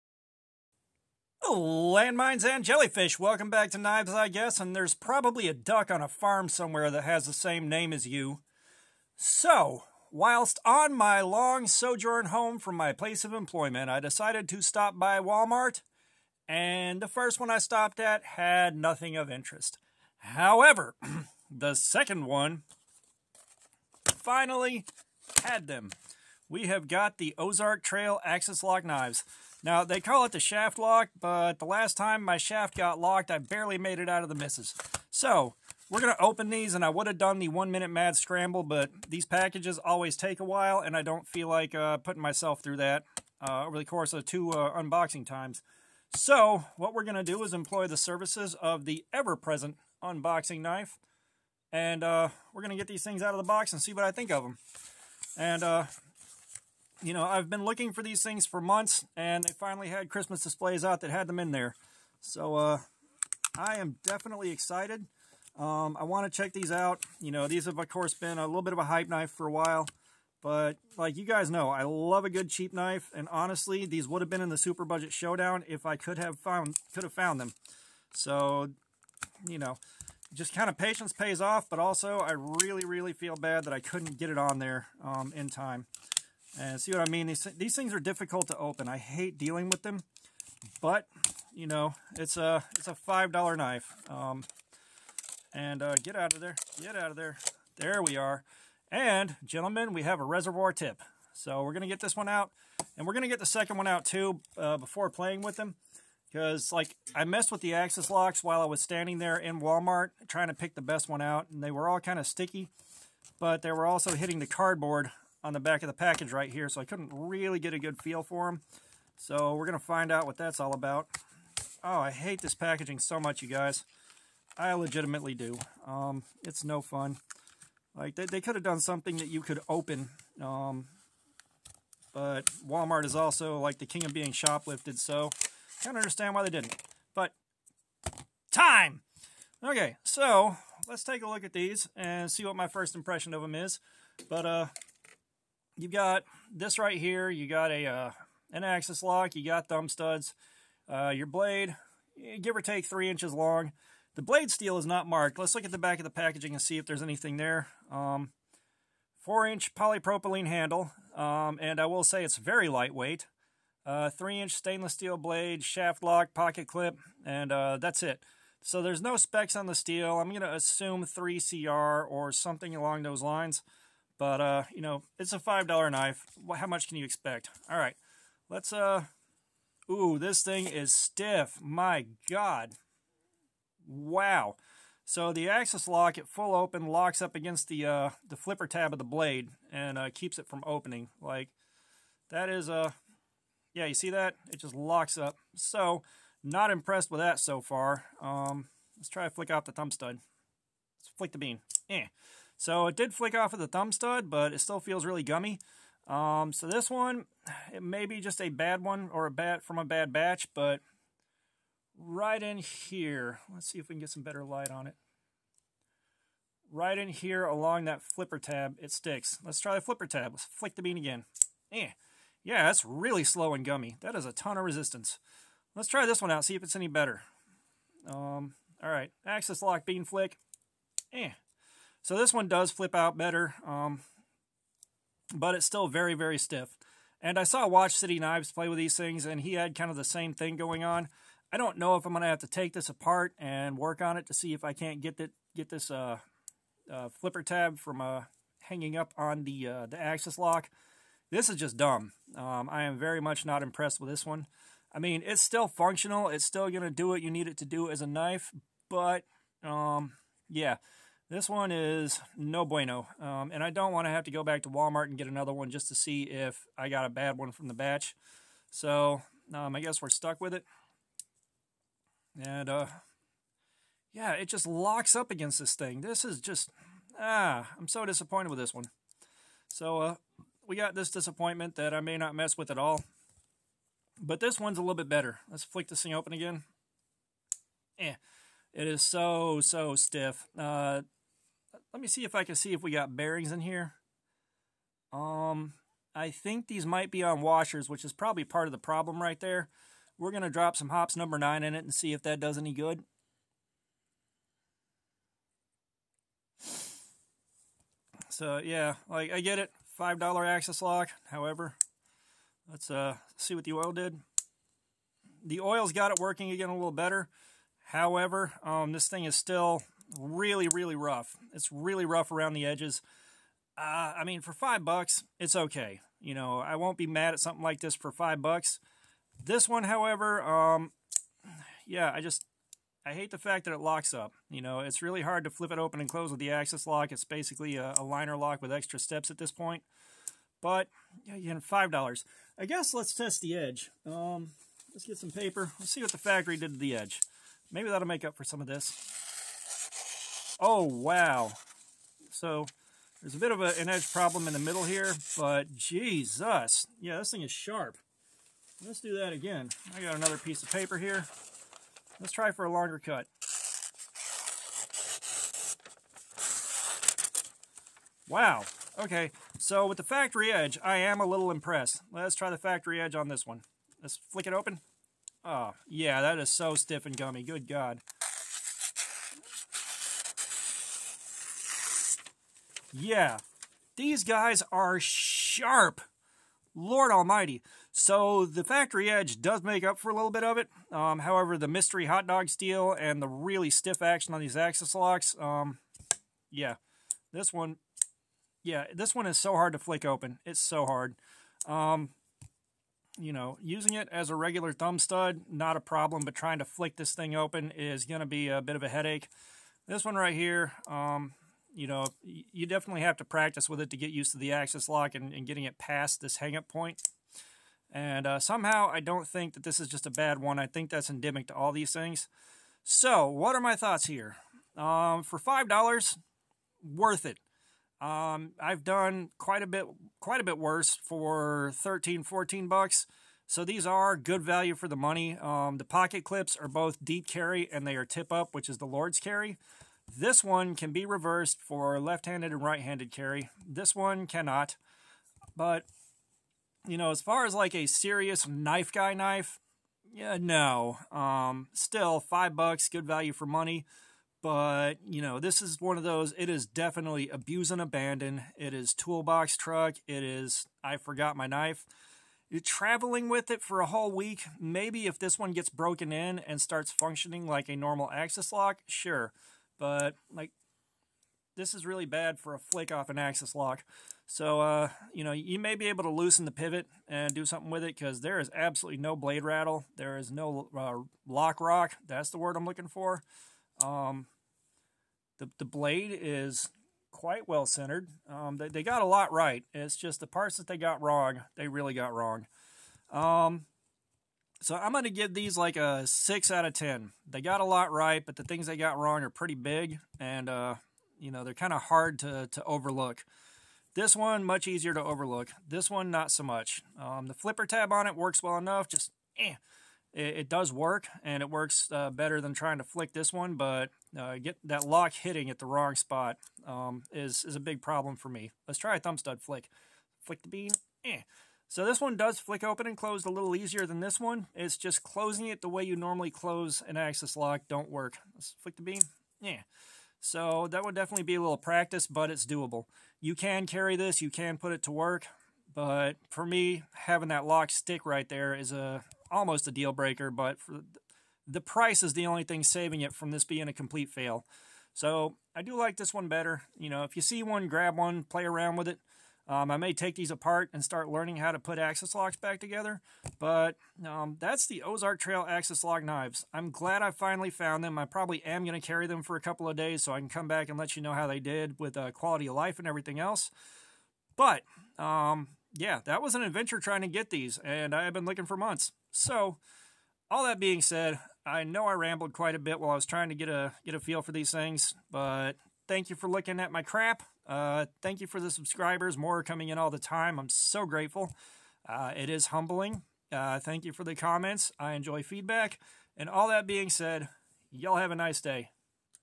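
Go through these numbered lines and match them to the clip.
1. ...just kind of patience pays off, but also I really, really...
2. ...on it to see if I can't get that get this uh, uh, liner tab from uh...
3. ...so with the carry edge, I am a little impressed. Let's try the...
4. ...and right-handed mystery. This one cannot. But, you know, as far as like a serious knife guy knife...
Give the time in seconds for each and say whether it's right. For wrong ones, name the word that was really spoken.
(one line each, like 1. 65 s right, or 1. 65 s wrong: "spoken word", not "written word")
1. 80 s right
2. 244 s wrong: "flipper", not "liner"
3. 369 s wrong: "factory", not "carry"
4. 442 s wrong: "carry", not "mystery".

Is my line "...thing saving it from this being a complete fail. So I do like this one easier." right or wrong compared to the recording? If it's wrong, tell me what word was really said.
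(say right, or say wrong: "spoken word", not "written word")
wrong: "better", not "easier".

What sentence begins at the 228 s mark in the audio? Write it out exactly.
Um, all right, axis lock bean flick.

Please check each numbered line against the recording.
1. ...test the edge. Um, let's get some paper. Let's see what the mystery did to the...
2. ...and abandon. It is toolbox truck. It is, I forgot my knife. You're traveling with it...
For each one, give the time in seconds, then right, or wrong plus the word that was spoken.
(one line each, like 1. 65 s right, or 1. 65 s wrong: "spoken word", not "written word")
1. 343 s wrong: "factory", not "mystery"
2. 457 s right.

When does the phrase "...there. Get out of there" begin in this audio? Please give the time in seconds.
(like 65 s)
96 s.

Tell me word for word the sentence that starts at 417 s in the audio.
And uh, somehow I don't think that this is just a bad one.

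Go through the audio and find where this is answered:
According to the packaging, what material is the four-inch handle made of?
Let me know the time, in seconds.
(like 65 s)
159 s.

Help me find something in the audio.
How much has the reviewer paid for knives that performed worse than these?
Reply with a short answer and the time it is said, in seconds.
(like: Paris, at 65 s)
13 to 14 dollars, at 431 s.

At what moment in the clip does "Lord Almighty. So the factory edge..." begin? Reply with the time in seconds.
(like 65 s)
386 s.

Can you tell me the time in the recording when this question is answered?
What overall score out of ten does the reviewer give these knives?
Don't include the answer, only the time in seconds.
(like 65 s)
496 s.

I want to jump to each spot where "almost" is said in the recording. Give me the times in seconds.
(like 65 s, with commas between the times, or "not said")
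539 s.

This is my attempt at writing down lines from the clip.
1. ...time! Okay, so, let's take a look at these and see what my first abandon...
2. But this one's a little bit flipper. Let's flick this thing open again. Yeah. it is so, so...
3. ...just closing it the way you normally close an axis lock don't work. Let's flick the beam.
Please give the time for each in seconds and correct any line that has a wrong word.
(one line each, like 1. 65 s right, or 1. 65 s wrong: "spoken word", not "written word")
1. 138 s wrong: "impression", not "abandon"
2. 284 s wrong: "better", not "flipper"
3. 524 s right.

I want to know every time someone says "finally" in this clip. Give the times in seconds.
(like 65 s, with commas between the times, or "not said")
24 s, 59 s, 557 s.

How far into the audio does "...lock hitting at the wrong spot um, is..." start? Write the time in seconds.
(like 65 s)
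514 s.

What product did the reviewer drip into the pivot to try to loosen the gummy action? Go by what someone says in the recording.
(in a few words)
Hoppe's number 9.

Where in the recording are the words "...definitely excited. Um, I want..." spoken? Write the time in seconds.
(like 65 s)
64 s.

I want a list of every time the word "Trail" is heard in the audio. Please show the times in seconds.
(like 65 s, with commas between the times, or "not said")
27 s, 555 s.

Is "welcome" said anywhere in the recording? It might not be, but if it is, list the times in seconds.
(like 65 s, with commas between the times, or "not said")
3 s.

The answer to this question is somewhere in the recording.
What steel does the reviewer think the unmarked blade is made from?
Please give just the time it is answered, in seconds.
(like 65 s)
171 s.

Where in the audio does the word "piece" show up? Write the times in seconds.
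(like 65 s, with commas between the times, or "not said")
360 s.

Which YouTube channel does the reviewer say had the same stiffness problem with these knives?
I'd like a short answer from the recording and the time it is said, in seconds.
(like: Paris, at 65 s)
Watch City Knives, at 237 s.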